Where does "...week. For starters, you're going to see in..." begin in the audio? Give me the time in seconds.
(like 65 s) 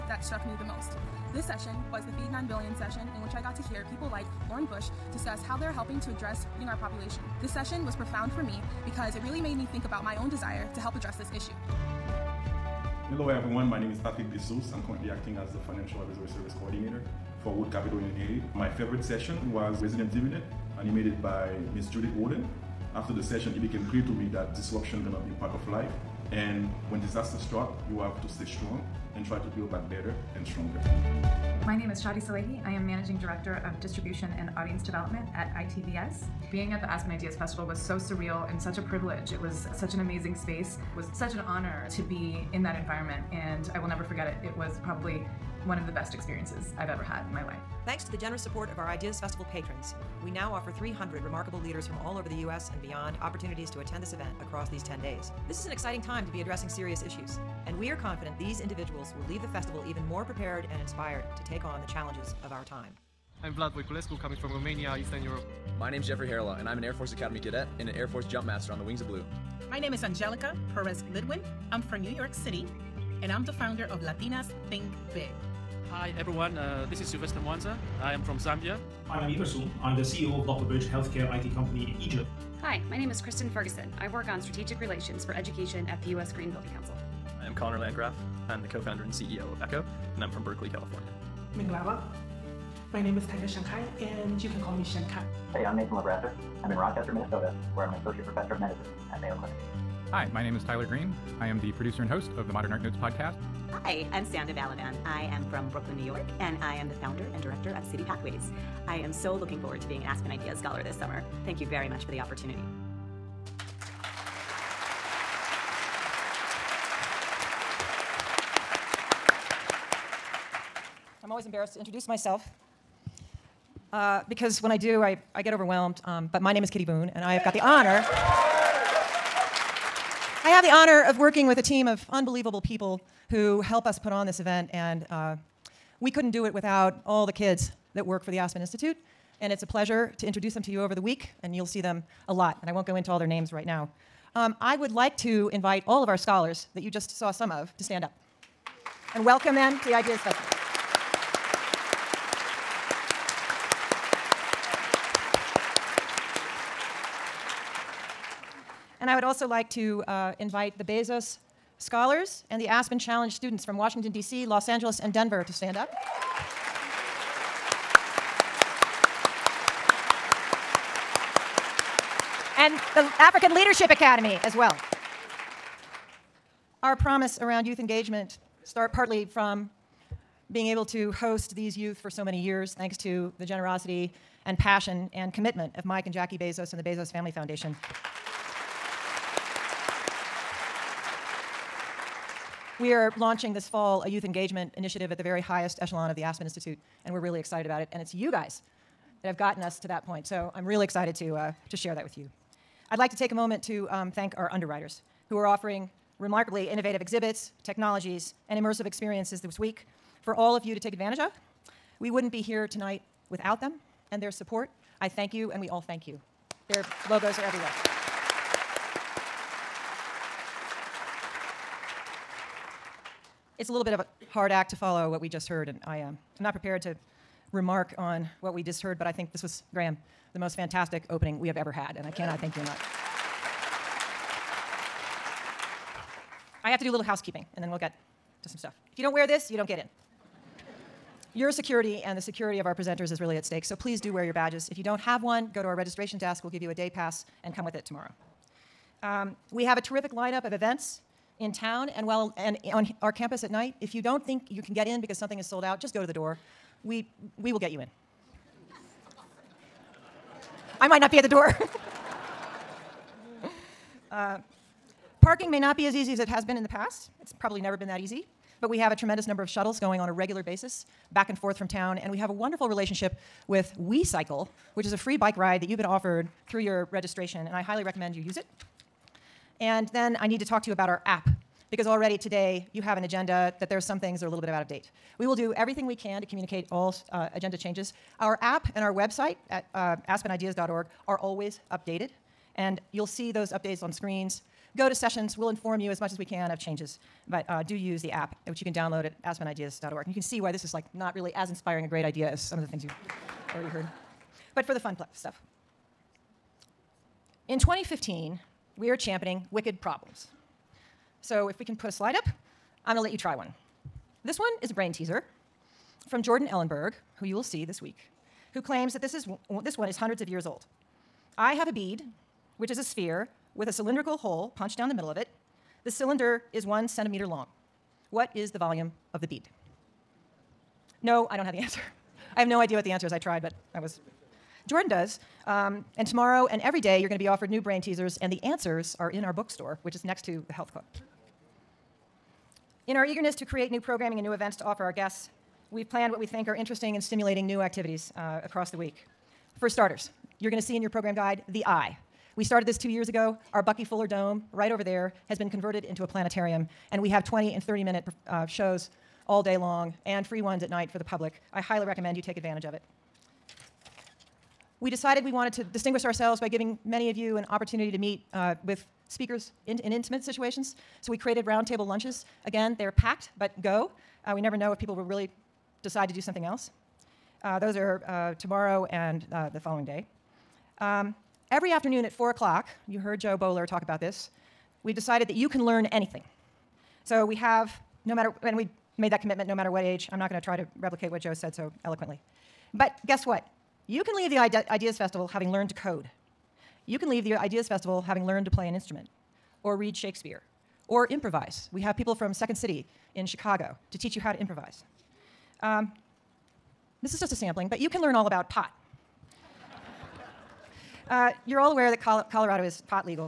348 s.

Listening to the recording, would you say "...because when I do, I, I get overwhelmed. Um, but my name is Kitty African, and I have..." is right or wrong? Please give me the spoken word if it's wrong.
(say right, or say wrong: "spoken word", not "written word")
wrong: "Boone", not "African".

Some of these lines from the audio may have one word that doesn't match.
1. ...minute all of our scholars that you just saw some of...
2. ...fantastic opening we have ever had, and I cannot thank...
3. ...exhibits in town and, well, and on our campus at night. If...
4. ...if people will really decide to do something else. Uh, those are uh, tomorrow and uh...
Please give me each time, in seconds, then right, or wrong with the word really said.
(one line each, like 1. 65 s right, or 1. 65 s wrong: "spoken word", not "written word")
1. 145 s wrong: "invite", not "minute"
2. 230 s right
3. 250 s wrong: "events", not "exhibits"
4. 374 s right.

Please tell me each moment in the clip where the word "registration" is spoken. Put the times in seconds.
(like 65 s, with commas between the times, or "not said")
245 s, 276 s.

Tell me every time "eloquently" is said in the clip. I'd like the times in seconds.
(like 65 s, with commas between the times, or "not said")
391 s.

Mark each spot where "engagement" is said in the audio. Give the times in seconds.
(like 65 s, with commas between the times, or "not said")
177 s, 194 s.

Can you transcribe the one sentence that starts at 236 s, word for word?
I have to do a little housekeeping, and then we'll get to some stuff.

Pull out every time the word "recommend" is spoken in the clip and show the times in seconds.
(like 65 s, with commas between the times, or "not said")
277 s, 361 s.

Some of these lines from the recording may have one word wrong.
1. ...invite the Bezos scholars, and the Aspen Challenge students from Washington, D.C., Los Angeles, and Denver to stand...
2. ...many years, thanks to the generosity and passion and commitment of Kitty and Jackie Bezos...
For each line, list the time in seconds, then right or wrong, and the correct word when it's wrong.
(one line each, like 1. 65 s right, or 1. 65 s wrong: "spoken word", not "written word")
1. 160 s right
2. 182 s wrong: "Mike", not "Kitty".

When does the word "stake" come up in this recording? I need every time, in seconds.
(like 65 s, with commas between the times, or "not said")
243 s.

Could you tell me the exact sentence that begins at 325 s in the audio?
The cylinder is one centimeter long.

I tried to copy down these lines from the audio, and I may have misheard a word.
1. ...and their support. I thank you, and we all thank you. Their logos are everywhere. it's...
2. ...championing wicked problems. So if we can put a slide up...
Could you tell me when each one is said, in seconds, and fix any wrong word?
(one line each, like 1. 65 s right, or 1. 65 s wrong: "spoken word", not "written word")
1. 214 s right
2. 308 s right.